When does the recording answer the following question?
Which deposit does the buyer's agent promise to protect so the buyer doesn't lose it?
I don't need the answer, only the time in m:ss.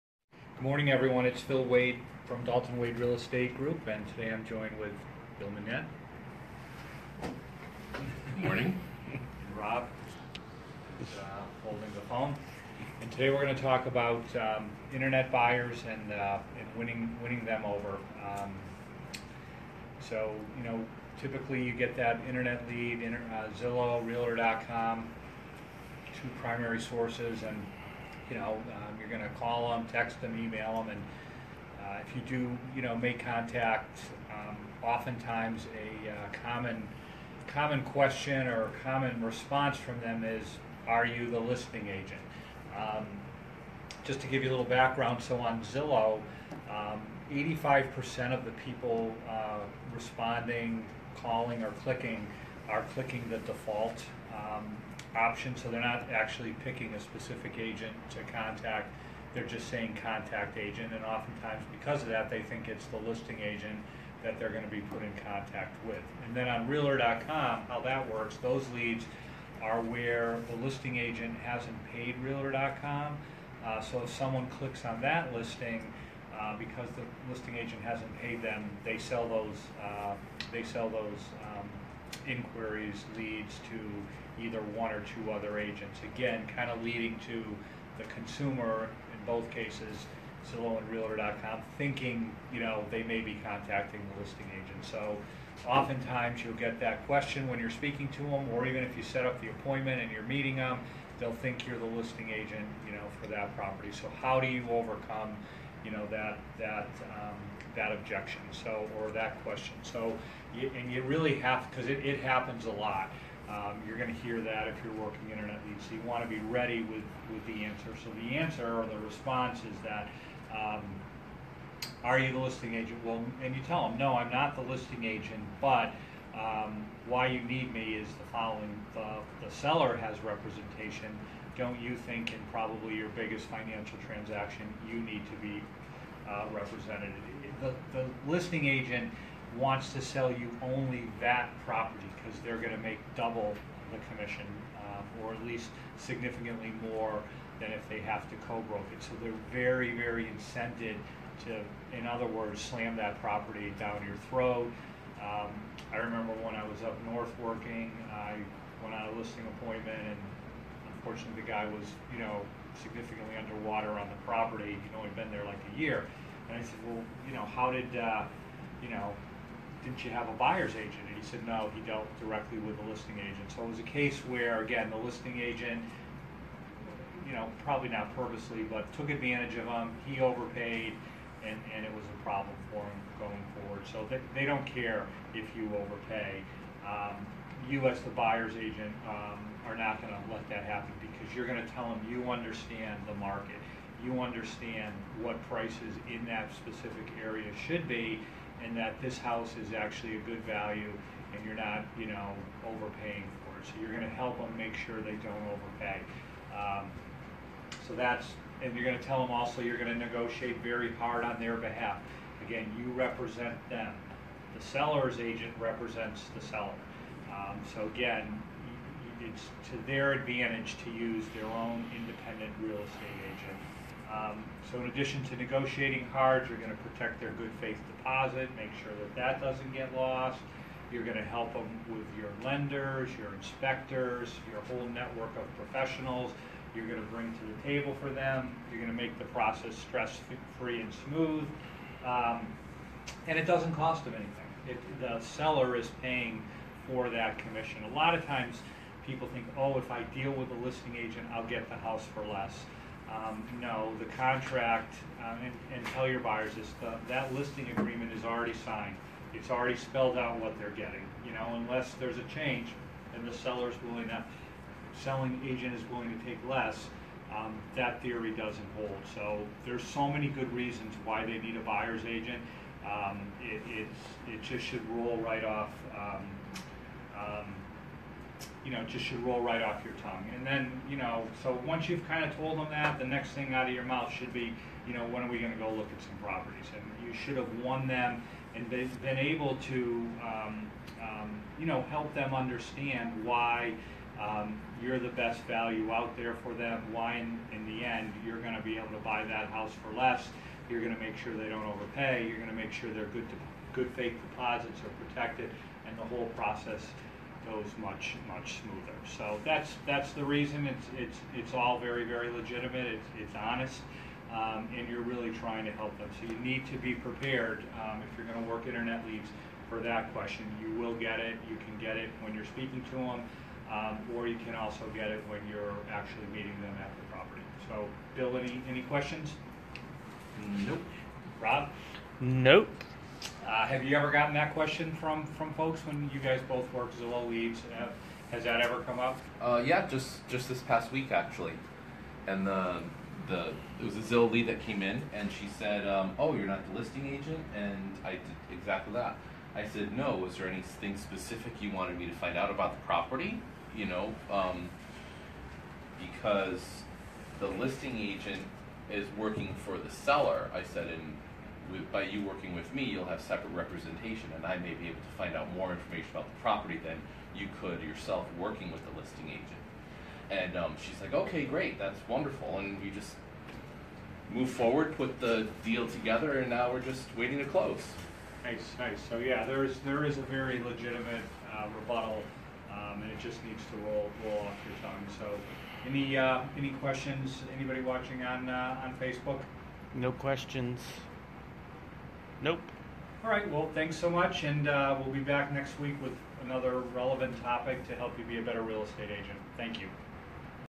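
3:47.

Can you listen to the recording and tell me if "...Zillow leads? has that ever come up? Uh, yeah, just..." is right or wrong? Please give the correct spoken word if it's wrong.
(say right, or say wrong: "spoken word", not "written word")
right.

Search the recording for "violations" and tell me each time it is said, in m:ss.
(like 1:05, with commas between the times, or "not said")
not said.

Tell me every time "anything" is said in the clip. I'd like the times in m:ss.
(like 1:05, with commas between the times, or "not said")
4:04, 5:50.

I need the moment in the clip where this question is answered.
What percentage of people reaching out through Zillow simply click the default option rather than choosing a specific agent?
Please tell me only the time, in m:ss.
0:47.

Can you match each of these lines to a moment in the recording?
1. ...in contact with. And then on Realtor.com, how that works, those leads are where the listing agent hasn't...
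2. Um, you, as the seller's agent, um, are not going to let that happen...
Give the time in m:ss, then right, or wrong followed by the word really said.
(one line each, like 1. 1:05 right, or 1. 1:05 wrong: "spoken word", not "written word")
1. 1:05 right
2. 3:06 wrong: "buyer", not "seller".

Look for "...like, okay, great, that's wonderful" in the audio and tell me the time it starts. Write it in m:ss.
6:11.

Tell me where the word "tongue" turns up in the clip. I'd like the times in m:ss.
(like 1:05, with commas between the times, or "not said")
4:39, 6:24.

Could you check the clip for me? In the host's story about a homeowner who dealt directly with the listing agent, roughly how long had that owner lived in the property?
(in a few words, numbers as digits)
A year.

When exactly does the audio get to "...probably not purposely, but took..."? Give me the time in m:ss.
2:57.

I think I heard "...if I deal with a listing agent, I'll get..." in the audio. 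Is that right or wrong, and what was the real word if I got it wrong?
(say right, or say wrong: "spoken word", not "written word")
right.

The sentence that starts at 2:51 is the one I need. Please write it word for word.
And he said, no, he dealt directly with the listing agent.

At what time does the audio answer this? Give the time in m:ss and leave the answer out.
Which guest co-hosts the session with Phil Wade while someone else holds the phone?
0:05.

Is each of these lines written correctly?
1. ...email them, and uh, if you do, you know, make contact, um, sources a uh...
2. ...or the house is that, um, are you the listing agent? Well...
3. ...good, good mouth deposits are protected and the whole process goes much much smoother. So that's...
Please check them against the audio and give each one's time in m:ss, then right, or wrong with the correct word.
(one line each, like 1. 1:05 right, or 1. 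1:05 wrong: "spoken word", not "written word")
1. 0:30 wrong: "oftentimes", not "sources"
2. 1:58 wrong: "response", not "house"
3. 5:03 wrong: "faith", not "mouth".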